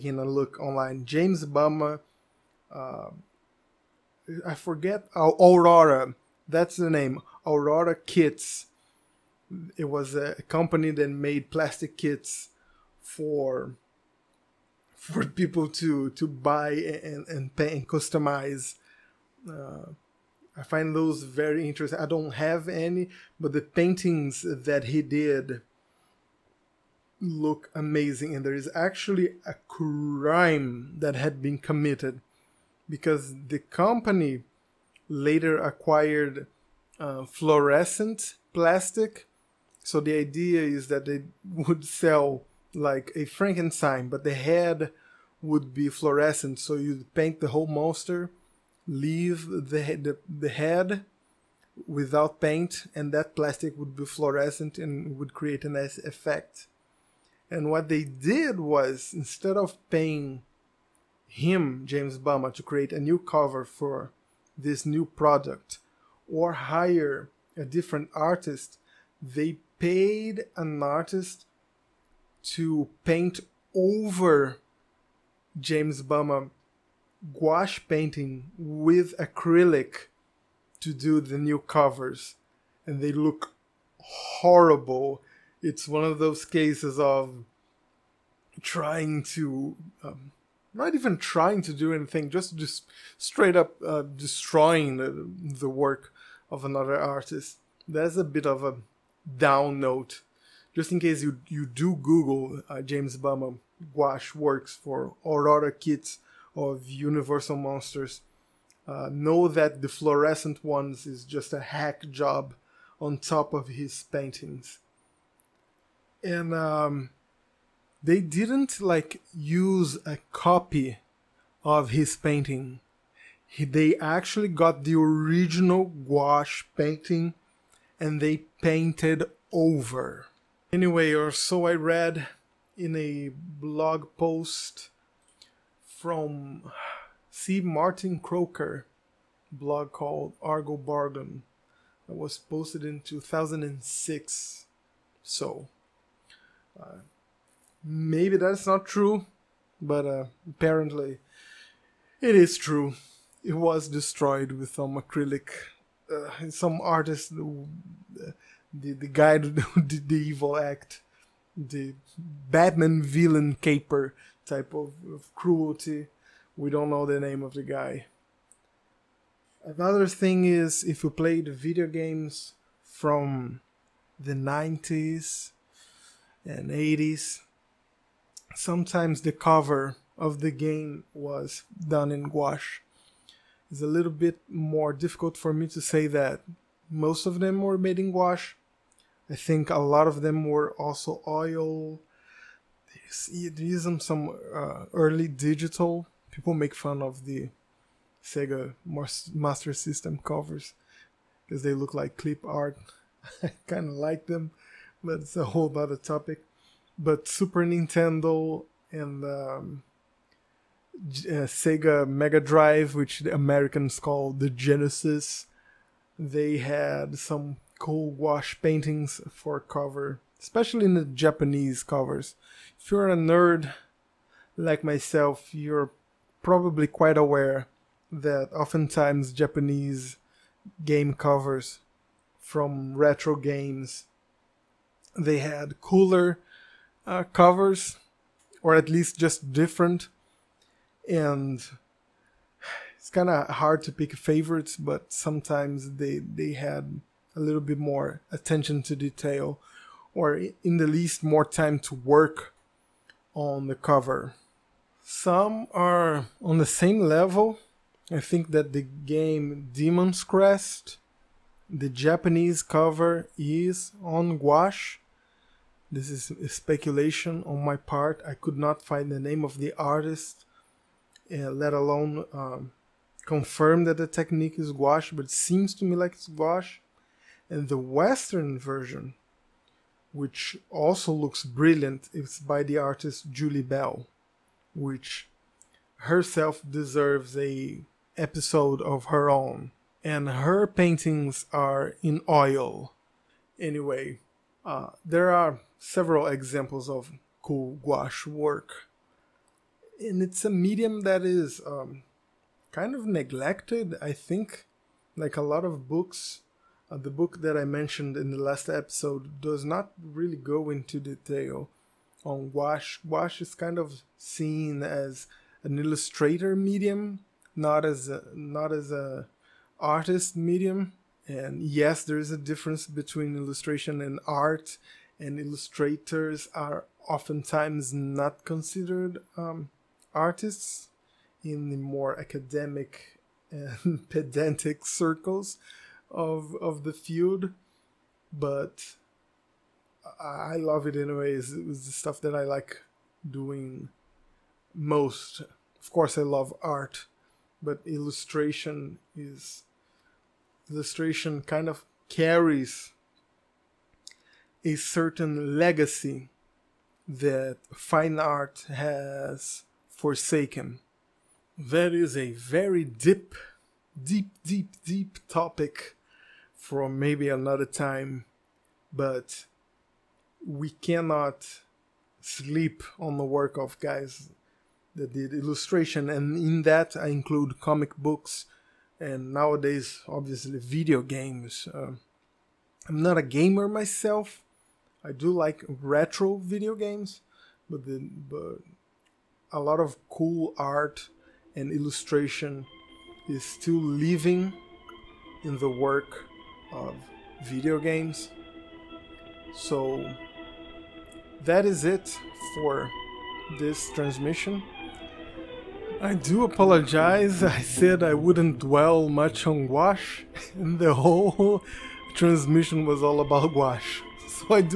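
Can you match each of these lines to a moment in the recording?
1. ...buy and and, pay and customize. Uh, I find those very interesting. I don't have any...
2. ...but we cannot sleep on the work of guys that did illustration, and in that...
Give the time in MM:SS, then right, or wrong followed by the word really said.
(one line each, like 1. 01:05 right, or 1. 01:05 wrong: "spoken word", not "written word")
1. 00:16 right
2. 06:08 right.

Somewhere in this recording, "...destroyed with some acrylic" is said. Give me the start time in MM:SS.
02:33.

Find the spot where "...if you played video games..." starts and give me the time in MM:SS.
02:50.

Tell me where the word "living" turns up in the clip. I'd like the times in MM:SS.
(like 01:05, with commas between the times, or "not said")
06:33.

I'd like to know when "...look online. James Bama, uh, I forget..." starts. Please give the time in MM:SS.
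00:00.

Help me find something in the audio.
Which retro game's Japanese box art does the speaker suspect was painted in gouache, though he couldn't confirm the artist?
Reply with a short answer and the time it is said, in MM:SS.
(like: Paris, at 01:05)
Demon's Crest, at 04:19.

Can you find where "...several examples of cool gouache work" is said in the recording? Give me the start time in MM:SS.
04:55.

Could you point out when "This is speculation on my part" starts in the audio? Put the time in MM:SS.
04:25.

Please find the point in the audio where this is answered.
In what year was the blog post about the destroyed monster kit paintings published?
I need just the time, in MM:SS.
02:23.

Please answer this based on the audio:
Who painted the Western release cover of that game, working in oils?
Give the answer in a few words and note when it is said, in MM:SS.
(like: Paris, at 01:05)
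Julie Bell, at 04:43.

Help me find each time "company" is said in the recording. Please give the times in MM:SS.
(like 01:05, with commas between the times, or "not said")
00:10, 00:33.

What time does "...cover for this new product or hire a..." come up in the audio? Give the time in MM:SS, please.
01:03.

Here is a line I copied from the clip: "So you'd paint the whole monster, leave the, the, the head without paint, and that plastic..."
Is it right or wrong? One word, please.
right.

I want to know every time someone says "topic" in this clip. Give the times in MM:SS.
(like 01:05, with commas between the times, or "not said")
03:25, 06:05.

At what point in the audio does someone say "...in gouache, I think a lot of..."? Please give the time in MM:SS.
03:07.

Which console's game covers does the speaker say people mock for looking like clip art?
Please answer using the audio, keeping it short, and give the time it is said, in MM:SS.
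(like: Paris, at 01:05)
Sega Master System, at 03:18.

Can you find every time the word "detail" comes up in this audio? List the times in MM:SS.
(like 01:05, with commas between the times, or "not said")
04:08, 05:10.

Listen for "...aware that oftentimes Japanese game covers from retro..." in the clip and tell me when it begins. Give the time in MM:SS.
03:47.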